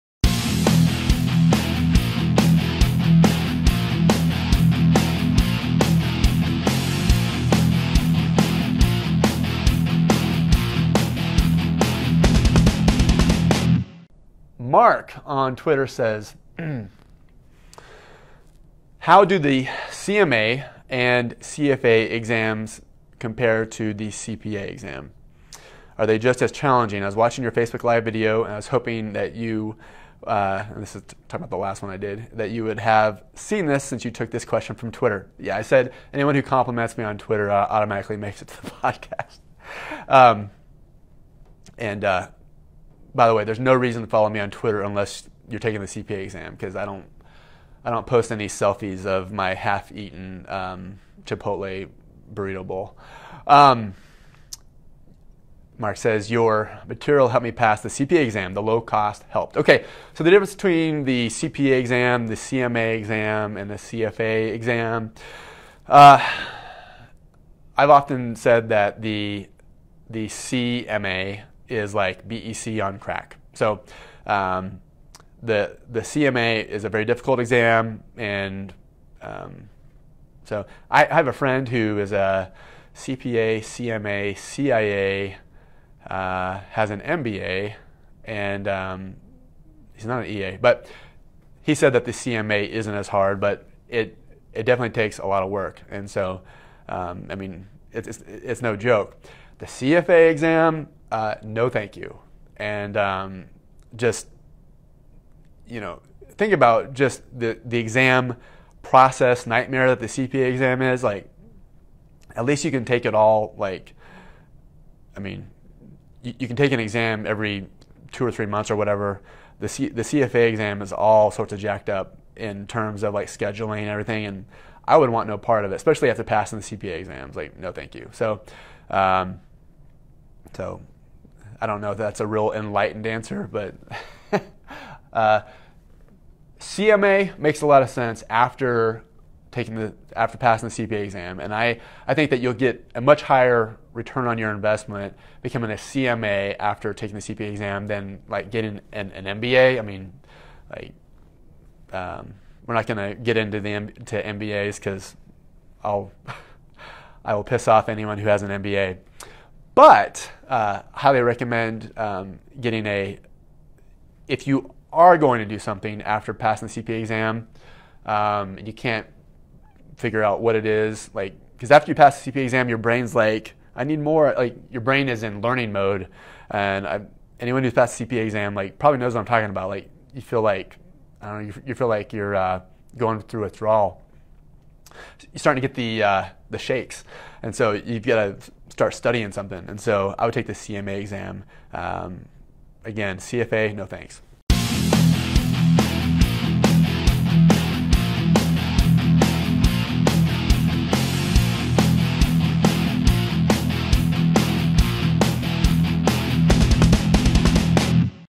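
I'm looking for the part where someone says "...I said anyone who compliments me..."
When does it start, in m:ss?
0:35.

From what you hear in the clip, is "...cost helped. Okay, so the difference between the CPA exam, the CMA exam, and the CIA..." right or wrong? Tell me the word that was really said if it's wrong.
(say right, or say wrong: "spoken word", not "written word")
wrong: "CFA", not "CIA".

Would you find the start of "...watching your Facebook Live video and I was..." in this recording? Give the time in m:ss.
0:27.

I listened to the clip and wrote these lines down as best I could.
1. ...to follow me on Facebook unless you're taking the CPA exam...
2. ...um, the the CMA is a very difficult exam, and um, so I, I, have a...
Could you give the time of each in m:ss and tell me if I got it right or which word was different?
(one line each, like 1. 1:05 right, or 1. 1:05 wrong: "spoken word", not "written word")
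1. 0:44 wrong: "Twitter", not "Facebook"
2. 1:14 right.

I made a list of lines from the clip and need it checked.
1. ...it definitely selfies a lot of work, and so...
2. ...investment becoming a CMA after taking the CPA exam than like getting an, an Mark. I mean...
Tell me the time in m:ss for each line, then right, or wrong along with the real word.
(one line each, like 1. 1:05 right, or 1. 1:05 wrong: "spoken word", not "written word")
1. 1:34 wrong: "takes", not "selfies"
2. 2:24 wrong: "MBA", not "Mark".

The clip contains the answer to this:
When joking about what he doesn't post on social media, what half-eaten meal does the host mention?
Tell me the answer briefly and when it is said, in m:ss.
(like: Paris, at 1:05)
Chipotle burrito bowl, at 0:51.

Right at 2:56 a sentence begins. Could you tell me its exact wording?
And I, anyone who's passed the CPA exam, like, probably knows what I'm talking about.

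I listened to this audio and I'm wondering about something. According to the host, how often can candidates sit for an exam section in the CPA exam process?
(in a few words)
every two or three months.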